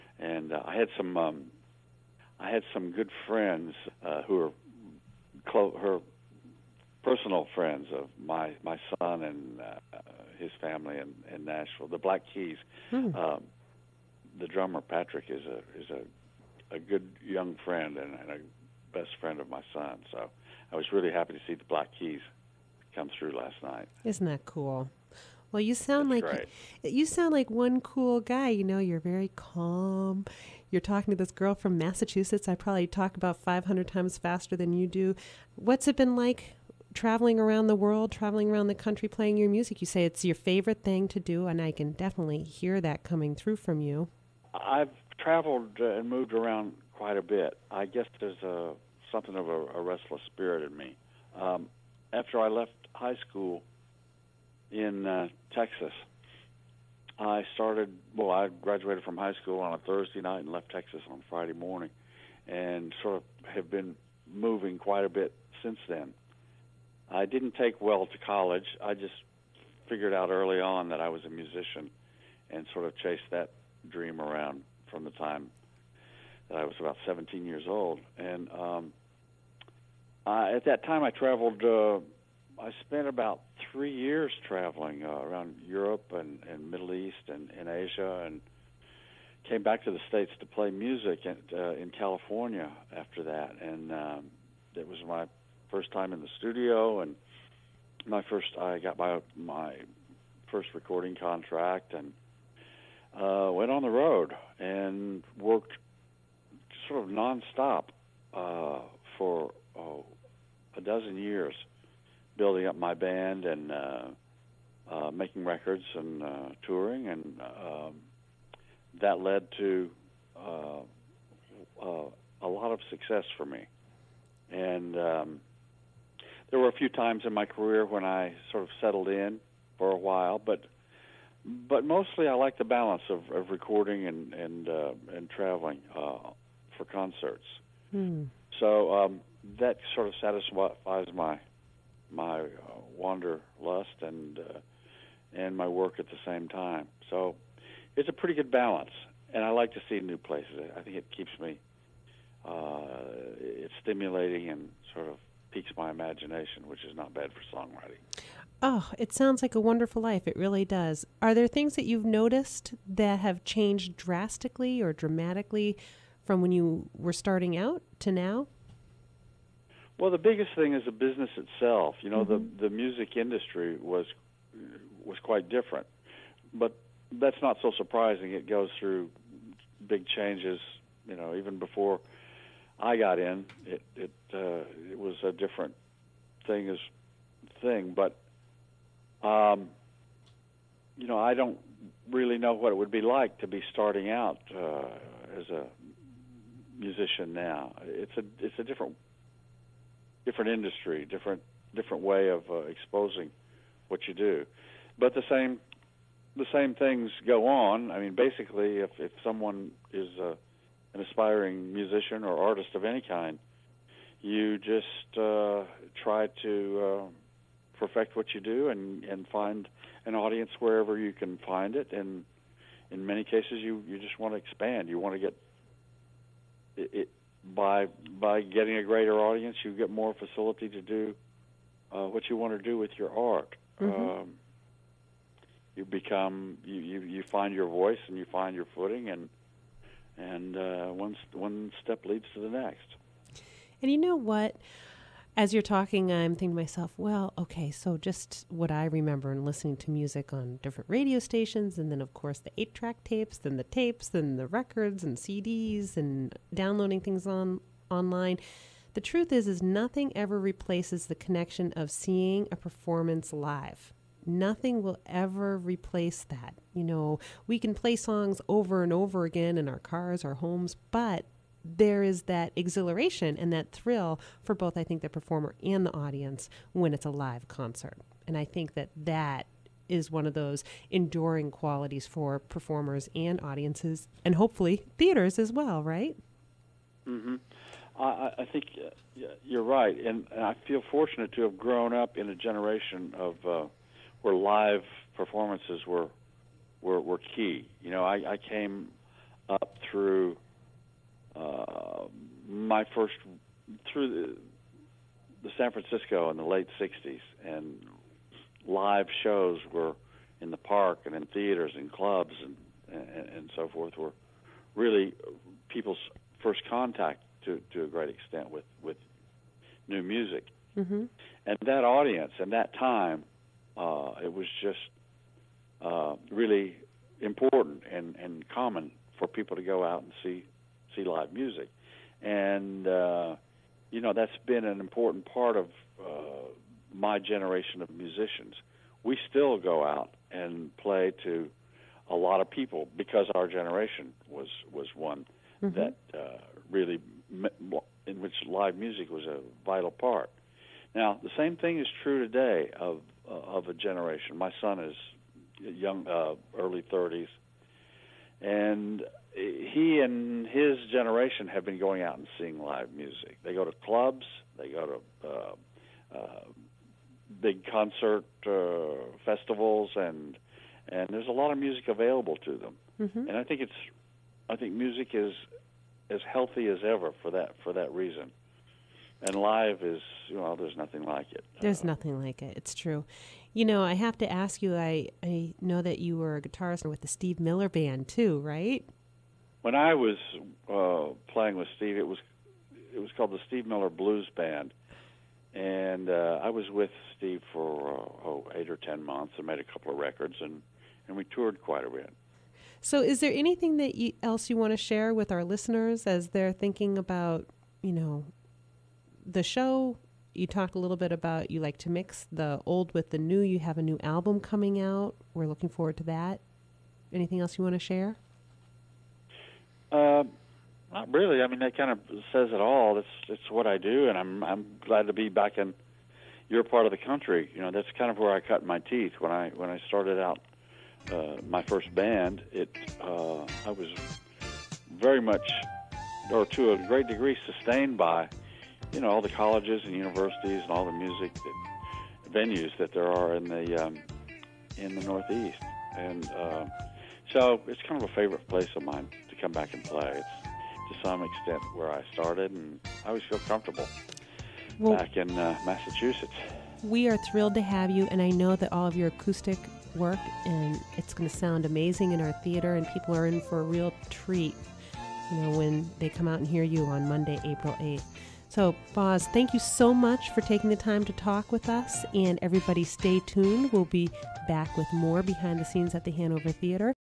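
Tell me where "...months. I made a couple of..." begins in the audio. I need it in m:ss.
6:39.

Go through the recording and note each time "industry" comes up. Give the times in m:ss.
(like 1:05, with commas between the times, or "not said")
2:53, 3:20.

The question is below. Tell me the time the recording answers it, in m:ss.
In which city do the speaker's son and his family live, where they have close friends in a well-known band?
0:11.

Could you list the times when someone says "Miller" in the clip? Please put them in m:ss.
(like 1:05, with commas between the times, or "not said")
6:27, 6:33.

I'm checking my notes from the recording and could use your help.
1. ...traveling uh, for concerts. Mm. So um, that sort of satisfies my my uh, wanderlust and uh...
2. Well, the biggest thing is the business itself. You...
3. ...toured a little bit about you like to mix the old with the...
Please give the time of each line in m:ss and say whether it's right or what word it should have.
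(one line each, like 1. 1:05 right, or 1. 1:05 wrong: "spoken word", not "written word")
1. 2:15 right
2. 2:49 right
3. 6:50 wrong: "talked", not "toured".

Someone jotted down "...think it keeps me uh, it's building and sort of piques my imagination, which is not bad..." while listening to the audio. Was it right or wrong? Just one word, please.
wrong.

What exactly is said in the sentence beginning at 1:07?
I didn't take well to college.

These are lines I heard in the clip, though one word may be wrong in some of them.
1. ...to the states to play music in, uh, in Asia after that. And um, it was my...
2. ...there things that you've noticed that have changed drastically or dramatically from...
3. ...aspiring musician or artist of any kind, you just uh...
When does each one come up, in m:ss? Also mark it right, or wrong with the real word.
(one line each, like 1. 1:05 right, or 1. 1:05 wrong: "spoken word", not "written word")
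1. 1:29 wrong: "California", not "Asia"
2. 2:41 right
3. 3:31 right.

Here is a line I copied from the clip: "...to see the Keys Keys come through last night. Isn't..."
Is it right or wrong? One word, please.
wrong.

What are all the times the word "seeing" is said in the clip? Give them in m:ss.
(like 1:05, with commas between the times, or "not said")
4:21, 6:02.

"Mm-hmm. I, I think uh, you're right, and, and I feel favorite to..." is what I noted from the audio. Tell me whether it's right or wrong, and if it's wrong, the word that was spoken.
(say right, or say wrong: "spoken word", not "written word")
wrong: "fortunate", not "favorite".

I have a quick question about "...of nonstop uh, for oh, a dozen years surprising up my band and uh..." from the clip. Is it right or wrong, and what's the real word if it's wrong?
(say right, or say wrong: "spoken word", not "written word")
wrong: "building", not "surprising".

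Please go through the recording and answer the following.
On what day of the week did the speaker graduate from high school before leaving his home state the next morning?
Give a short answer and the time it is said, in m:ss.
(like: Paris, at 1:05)
Thursday, at 0:59.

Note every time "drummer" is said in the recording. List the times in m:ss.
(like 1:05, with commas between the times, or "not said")
0:14.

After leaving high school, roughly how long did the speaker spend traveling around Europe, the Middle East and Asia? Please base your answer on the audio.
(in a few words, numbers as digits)
About 3 years.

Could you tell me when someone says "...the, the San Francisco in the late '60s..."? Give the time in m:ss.
5:04.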